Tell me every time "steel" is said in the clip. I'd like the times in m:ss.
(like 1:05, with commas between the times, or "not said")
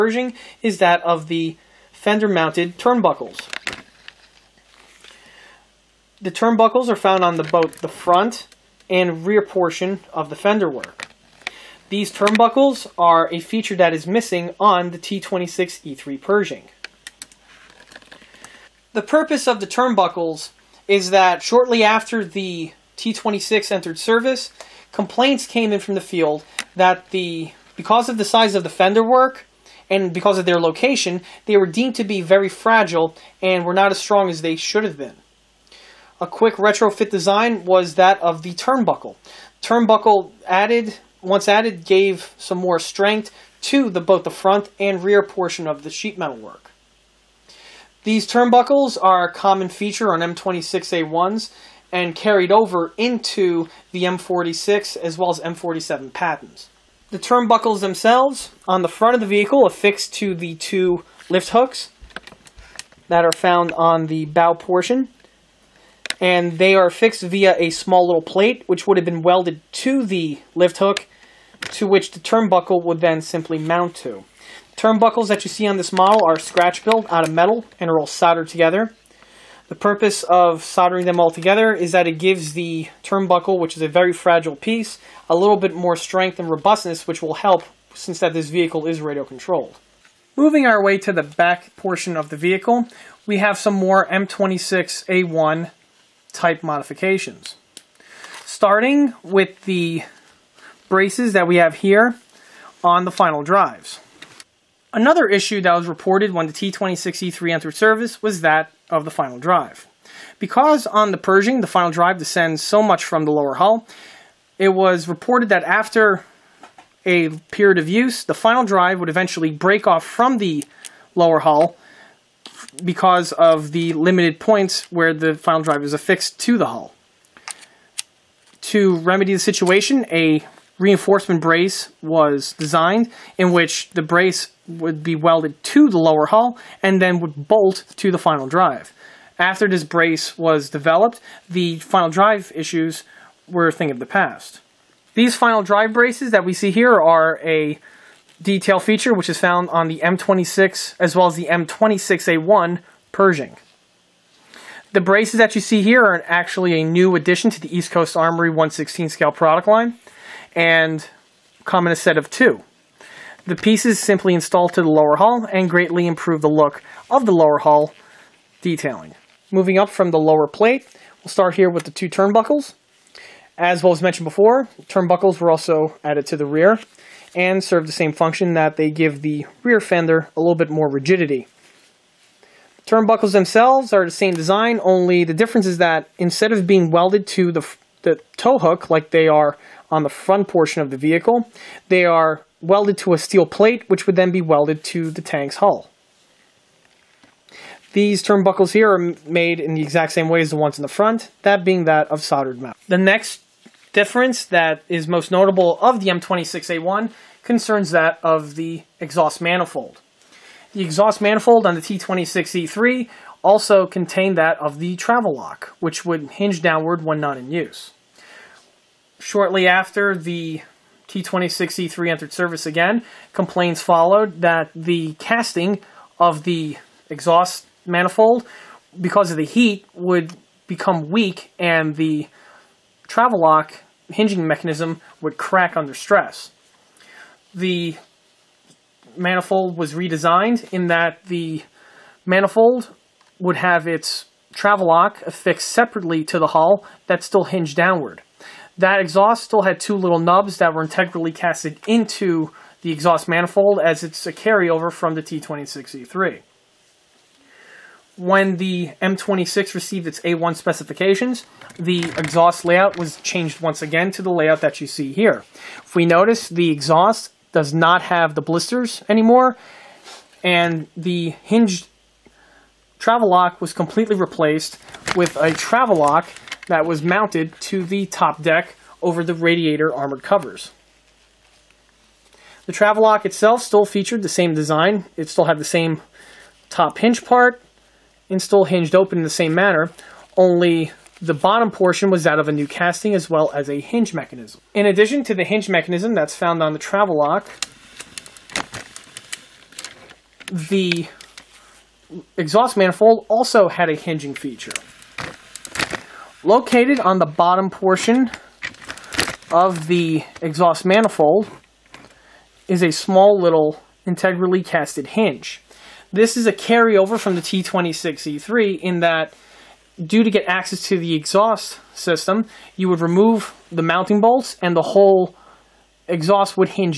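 3:13.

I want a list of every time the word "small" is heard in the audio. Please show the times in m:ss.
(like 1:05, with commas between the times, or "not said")
1:07, 5:12.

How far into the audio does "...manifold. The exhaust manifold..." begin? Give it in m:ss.
3:29.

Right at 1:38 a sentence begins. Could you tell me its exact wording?
Starting with the braces that we have here on the final drives.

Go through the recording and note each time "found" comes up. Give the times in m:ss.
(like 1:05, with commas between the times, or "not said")
0:06, 1:03, 2:29, 4:56.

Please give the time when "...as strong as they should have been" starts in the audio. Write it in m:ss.
0:33.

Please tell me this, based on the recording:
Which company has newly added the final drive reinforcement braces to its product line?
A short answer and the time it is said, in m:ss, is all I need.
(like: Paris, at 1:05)
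East Coast Armory, at 2:37.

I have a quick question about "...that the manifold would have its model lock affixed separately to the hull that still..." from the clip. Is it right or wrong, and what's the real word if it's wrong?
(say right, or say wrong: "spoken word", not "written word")
wrong: "travel", not "model".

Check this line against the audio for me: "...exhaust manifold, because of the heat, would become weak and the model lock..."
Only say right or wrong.
wrong.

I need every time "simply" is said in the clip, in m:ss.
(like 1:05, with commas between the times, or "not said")
1:13, 2:43.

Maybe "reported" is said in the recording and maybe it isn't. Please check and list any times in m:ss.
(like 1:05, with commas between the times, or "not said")
1:45, 1:55.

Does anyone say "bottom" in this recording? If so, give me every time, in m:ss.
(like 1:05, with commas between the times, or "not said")
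4:51, 5:07.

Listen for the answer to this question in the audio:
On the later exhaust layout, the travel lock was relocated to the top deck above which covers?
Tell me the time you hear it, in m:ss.
4:39.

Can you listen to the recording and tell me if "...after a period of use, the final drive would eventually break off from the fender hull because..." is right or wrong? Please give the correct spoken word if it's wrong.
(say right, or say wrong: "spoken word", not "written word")
wrong: "lower", not "fender".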